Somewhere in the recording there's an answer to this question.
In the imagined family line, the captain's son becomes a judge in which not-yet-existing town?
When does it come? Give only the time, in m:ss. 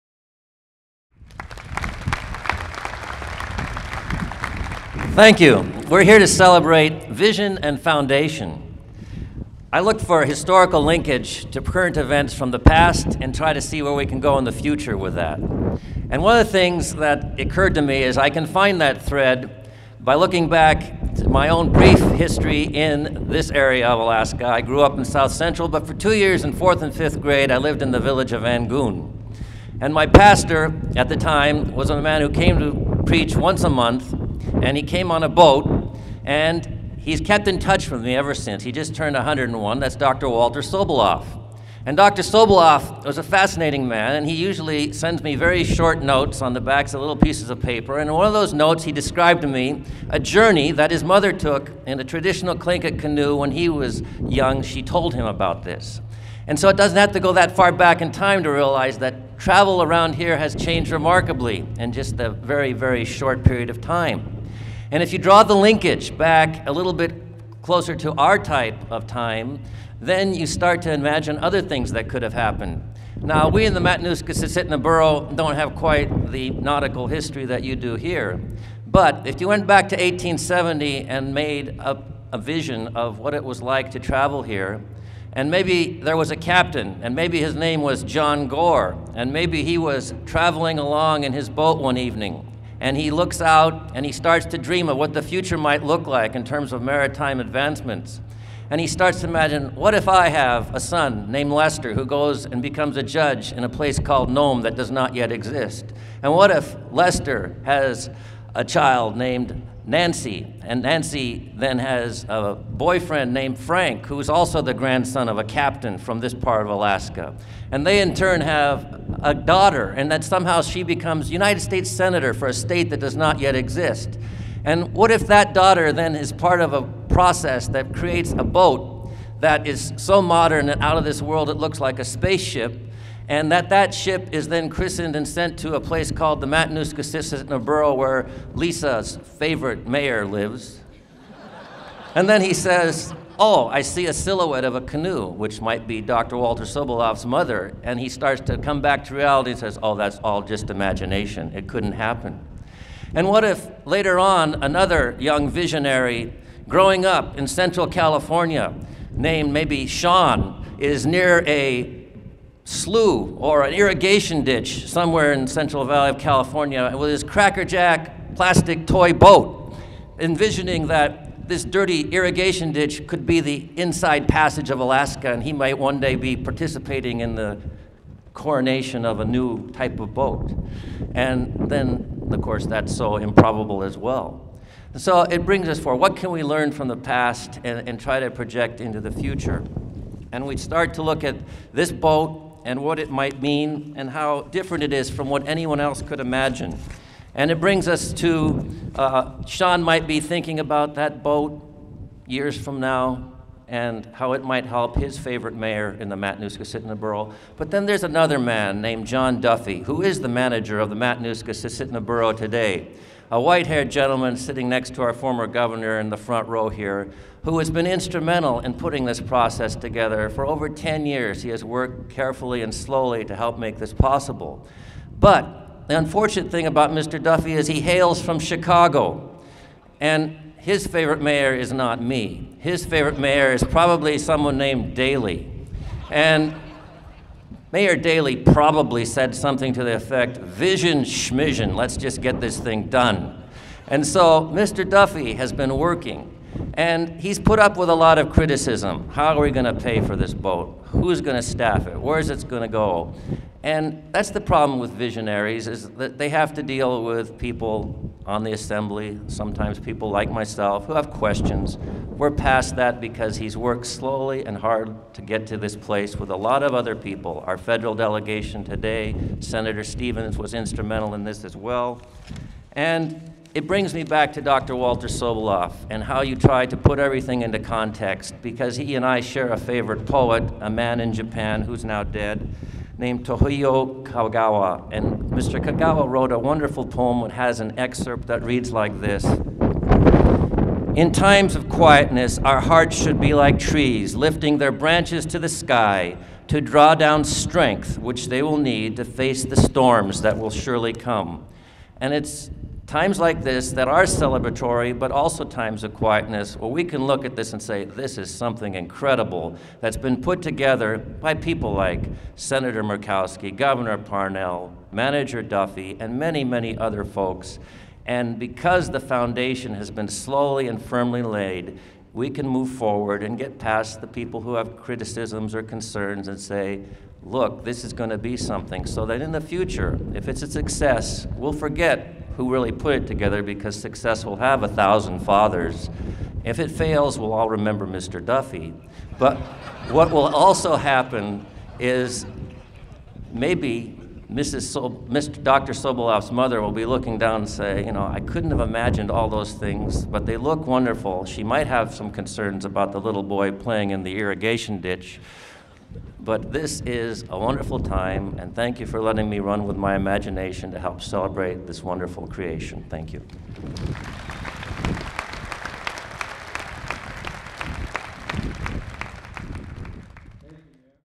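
1:44.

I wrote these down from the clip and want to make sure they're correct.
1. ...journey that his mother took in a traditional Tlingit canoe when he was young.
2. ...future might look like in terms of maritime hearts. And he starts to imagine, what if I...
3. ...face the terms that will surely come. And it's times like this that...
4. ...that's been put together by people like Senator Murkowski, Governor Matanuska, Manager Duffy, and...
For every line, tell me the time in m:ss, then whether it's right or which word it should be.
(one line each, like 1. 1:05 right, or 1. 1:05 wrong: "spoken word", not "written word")
1. 0:50 right
2. 1:35 wrong: "advancements", not "hearts"
3. 4:59 wrong: "storms", not "terms"
4. 5:09 wrong: "Parnell", not "Matanuska".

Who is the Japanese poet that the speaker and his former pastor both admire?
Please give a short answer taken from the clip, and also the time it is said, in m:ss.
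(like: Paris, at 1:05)
Toyohiko Kagawa, at 4:43.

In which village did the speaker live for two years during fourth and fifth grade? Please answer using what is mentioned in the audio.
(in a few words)
Angoon.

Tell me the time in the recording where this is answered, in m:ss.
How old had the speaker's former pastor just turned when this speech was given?
0:39.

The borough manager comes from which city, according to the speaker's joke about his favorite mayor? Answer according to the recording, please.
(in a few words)
Chicago.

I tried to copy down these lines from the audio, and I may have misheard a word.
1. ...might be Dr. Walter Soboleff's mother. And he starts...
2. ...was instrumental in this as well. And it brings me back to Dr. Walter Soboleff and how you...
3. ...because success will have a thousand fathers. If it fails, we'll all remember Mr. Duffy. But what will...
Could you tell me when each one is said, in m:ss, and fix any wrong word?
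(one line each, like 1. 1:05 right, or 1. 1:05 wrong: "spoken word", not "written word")
1. 2:25 right
2. 4:30 right
3. 5:33 right.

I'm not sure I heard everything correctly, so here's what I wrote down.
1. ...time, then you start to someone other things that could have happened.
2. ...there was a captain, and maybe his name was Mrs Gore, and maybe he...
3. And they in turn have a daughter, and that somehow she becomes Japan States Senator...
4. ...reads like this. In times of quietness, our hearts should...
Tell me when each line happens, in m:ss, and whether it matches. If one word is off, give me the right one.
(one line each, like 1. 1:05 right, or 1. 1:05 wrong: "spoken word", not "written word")
1. 1:09 wrong: "imagine", not "someone"
2. 1:26 wrong: "John", not "Mrs"
3. 1:57 wrong: "United", not "Japan"
4. 4:48 right.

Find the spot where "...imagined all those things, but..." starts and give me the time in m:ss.
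5:48.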